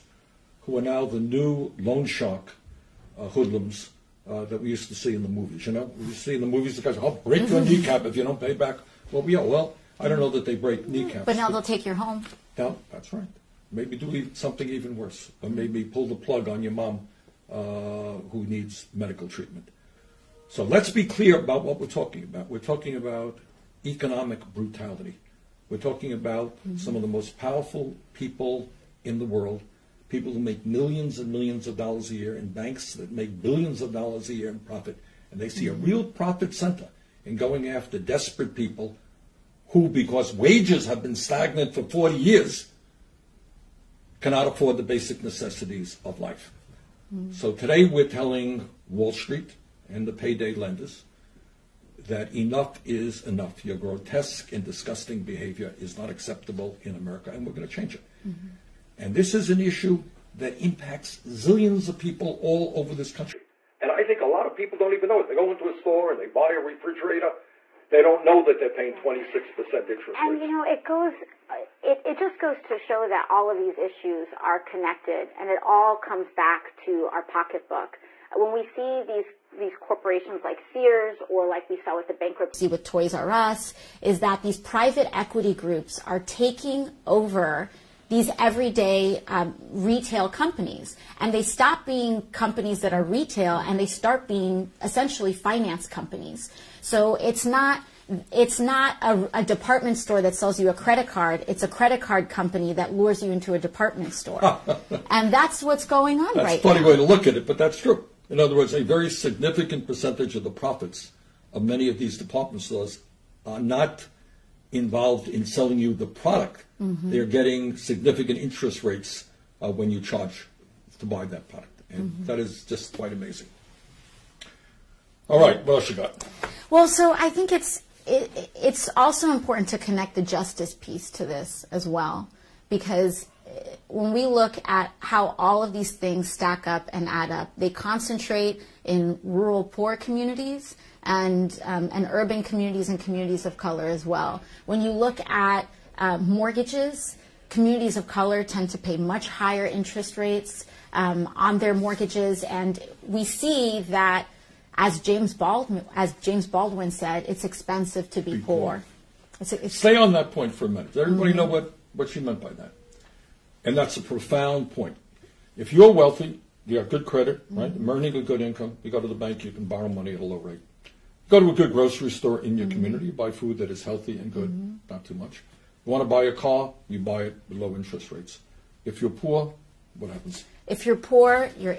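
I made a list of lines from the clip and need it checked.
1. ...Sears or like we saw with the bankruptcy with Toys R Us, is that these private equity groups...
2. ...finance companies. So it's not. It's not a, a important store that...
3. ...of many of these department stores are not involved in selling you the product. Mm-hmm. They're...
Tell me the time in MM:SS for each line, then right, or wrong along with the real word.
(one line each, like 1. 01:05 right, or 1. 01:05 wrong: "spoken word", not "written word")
1. 01:20 right
2. 01:35 wrong: "department", not "important"
3. 01:51 right.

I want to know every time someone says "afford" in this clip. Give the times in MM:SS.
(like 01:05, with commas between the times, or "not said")
00:44.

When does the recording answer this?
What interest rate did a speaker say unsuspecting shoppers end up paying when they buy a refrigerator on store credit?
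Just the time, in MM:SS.
01:08.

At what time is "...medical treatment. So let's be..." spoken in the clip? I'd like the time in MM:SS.
00:18.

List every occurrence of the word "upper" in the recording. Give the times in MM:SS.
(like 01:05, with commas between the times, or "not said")
not said.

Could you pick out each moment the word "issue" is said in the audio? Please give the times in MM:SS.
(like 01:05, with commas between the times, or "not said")
00:59, 01:13.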